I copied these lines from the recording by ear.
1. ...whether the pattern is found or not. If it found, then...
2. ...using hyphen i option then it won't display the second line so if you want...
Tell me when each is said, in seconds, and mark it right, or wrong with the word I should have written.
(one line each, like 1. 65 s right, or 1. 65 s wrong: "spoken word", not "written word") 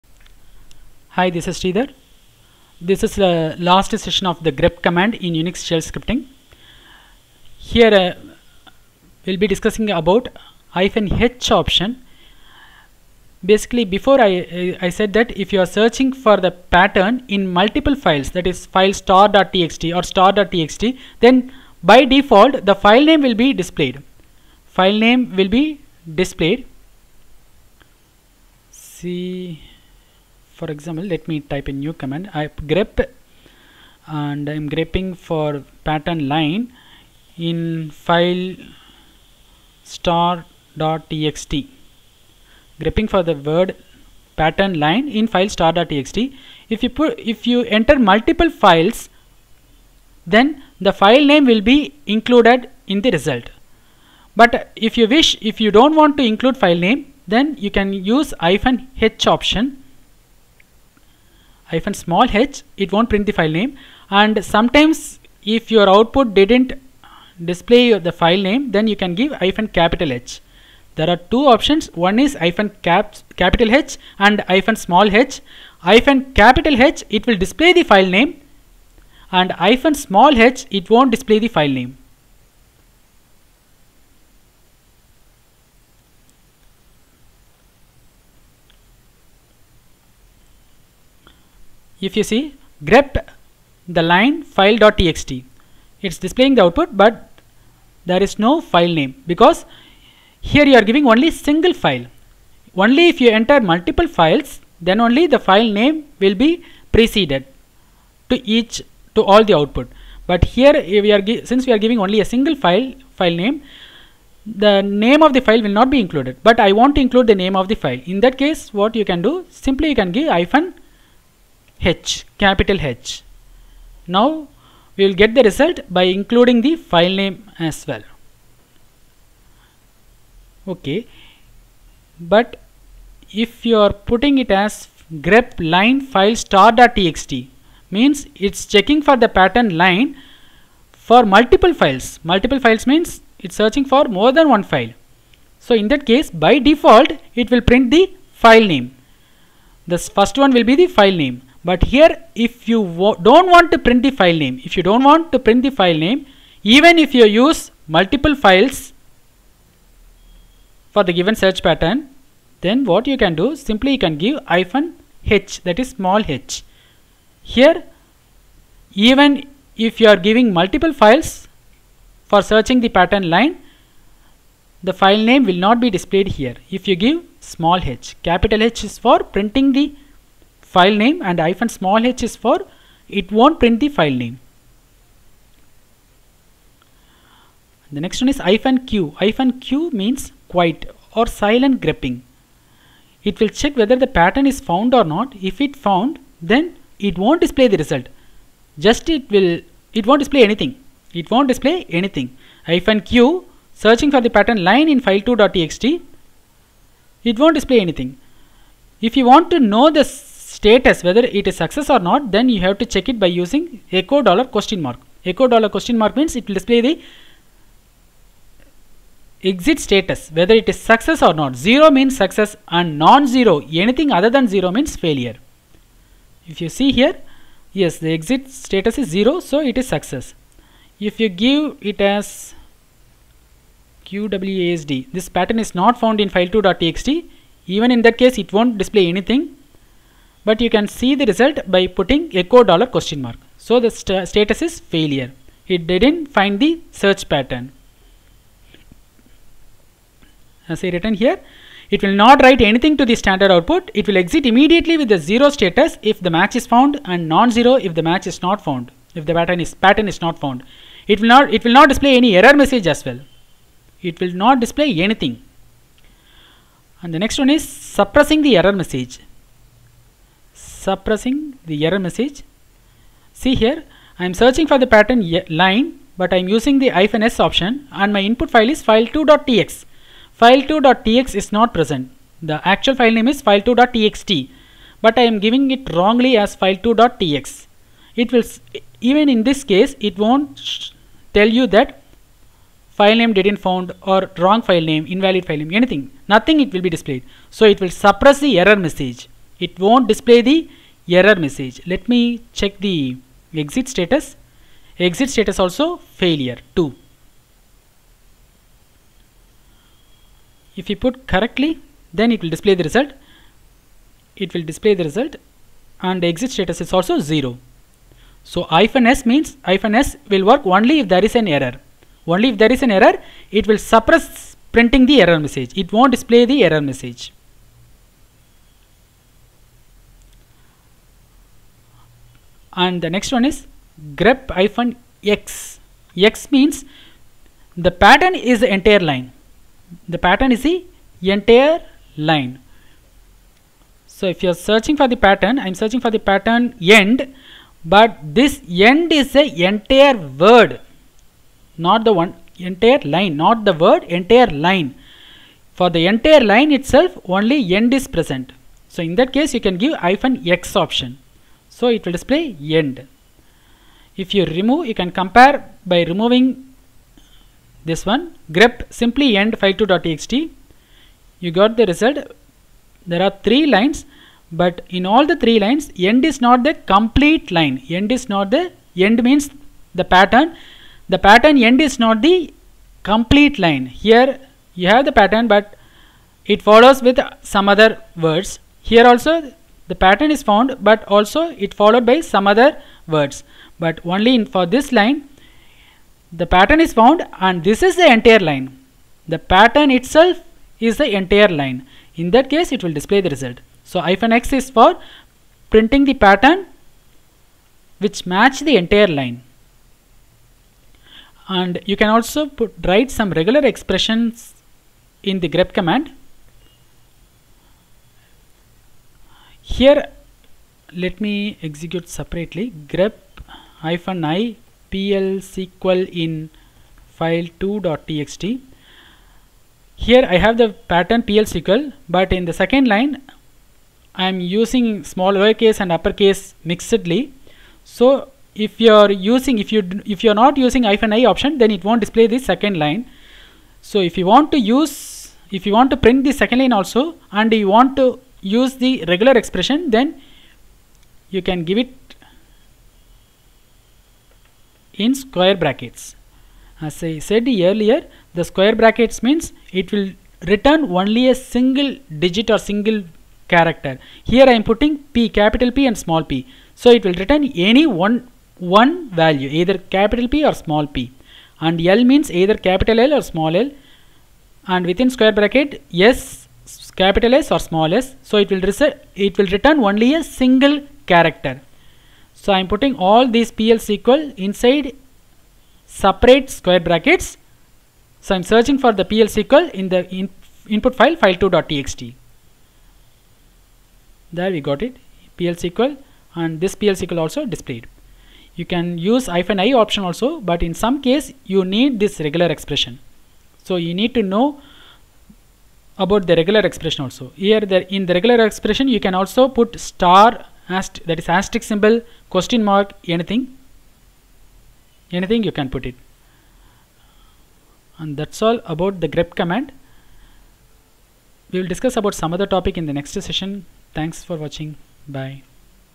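1. 193 s right
2. 440 s right.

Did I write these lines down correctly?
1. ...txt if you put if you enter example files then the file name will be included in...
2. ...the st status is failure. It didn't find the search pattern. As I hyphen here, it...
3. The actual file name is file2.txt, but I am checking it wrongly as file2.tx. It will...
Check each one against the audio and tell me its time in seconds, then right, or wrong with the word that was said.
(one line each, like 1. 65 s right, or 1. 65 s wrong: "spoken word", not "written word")
1. 45 s wrong: "multiple", not "example"
2. 243 s wrong: "written", not "hyphen"
3. 282 s wrong: "giving", not "checking".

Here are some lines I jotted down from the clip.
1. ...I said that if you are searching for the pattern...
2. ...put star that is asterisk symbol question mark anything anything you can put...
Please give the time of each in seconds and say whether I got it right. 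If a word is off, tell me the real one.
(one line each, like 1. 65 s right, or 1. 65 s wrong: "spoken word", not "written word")
1. 14 s right
2. 509 s right.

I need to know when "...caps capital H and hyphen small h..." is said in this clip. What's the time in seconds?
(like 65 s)
72 s.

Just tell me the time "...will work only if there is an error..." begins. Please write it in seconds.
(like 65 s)
320 s.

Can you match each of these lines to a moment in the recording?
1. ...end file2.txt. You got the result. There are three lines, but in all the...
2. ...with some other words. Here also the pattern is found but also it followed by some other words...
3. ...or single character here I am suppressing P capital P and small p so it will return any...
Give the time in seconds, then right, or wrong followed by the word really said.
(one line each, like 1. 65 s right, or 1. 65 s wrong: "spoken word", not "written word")
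1. 369 s right
2. 387 s right
3. 462 s wrong: "putting", not "suppressing".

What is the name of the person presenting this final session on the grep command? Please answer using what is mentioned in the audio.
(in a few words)
Sridhar.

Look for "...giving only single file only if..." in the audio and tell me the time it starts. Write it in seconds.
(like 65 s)
100 s.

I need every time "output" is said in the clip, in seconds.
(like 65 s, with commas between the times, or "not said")
65 s, 96 s, 109 s, 253 s.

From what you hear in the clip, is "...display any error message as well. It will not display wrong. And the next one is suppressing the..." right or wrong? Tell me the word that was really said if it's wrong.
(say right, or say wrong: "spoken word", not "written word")
wrong: "anything", not "wrong".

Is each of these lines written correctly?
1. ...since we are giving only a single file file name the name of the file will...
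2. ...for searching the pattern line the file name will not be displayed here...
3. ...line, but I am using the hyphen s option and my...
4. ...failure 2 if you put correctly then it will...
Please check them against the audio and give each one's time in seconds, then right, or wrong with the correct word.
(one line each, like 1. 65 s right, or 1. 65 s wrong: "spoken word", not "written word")
1. 111 s right
2. 172 s right
3. 275 s right
4. 306 s right.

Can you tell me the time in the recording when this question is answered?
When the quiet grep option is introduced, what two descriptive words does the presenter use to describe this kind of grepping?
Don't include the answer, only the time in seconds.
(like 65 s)
190 s.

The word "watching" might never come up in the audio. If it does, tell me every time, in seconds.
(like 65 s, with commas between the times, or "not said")
524 s.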